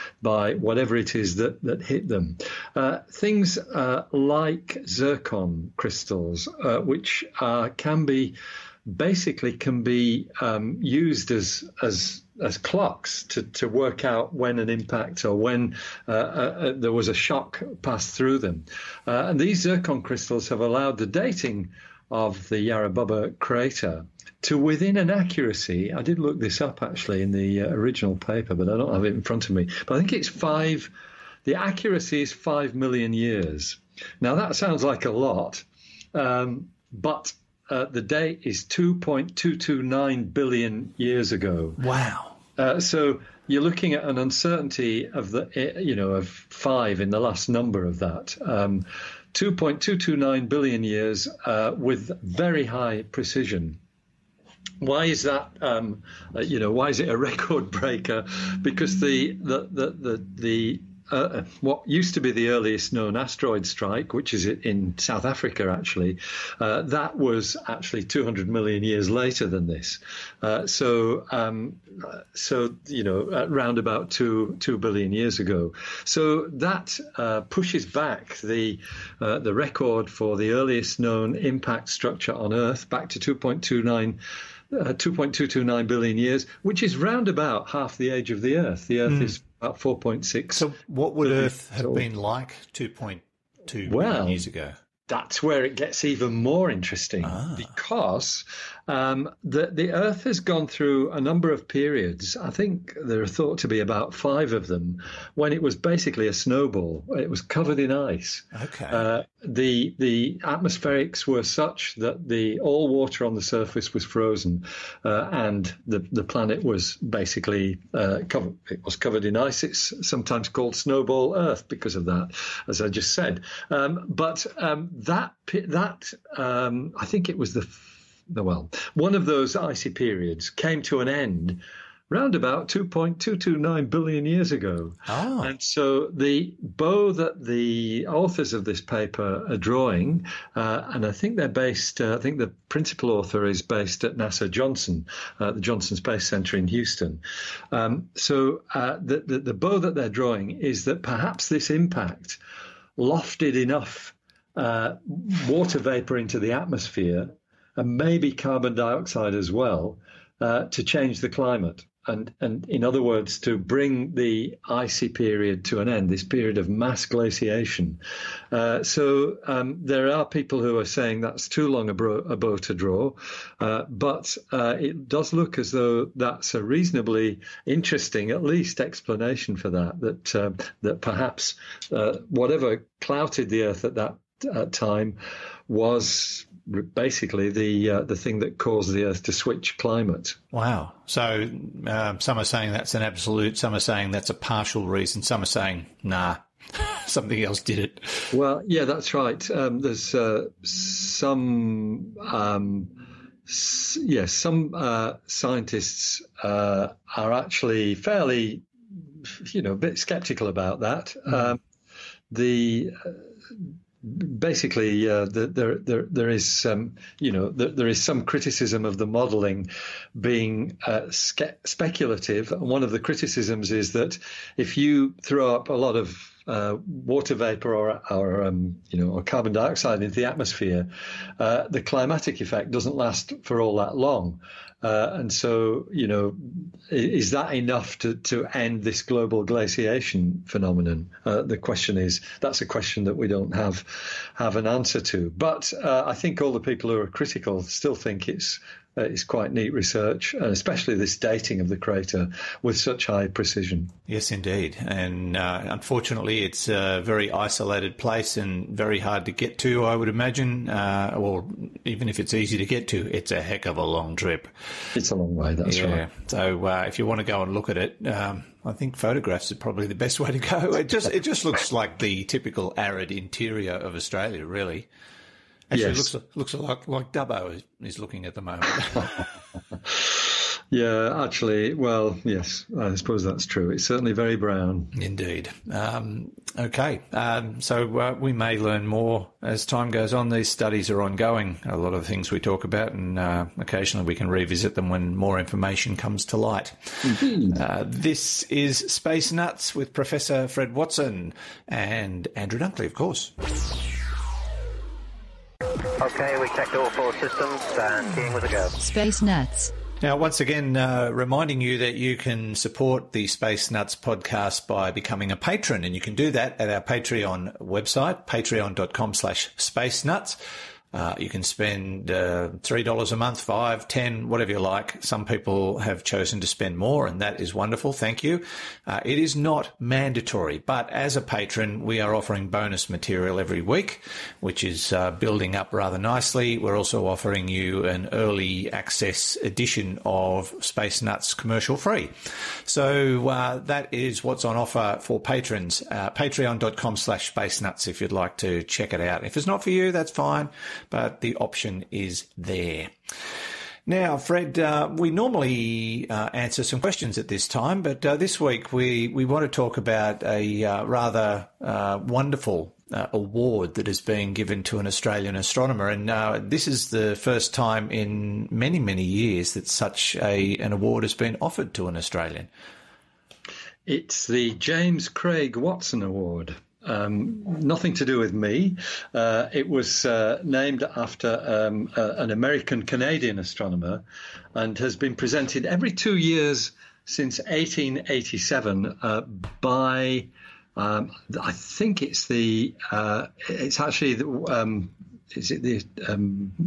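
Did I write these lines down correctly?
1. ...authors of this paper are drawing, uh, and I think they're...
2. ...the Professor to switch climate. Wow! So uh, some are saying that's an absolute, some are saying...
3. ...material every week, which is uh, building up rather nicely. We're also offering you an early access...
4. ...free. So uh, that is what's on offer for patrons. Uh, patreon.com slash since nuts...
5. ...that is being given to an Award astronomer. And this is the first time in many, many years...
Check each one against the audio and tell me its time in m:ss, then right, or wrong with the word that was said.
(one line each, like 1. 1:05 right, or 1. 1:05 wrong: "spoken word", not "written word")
1. 2:18 right
2. 3:08 wrong: "Earth", not "Professor"
3. 5:32 right
4. 5:41 wrong: "space", not "since"
5. 6:03 wrong: "Australian", not "Award".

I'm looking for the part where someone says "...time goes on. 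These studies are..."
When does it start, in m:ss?
4:49.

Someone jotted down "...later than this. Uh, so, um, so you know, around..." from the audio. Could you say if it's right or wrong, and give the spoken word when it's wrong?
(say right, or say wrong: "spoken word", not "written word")
right.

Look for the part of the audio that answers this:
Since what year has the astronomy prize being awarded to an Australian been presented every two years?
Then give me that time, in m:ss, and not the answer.
6:27.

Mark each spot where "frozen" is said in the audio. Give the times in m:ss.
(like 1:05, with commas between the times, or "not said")
1:54.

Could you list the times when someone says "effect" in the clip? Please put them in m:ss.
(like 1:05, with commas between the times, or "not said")
3:52.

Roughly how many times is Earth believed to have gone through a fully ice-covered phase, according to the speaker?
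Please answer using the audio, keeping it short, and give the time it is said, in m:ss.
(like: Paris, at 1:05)
5, at 1:43.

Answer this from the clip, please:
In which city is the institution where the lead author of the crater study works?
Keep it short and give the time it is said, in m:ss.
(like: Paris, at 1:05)
Houston, at 2:26.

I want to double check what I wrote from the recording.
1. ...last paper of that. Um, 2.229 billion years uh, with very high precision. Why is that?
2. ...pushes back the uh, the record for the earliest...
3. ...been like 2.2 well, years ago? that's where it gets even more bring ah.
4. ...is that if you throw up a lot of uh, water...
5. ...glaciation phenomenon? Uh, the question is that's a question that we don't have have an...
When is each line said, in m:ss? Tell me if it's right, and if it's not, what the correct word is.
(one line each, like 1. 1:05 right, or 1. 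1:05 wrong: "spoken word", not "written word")
1. 0:47 wrong: "number", not "paper"
2. 1:17 right
3. 1:31 wrong: "interesting", not "bring"
4. 3:43 right
5. 3:59 right.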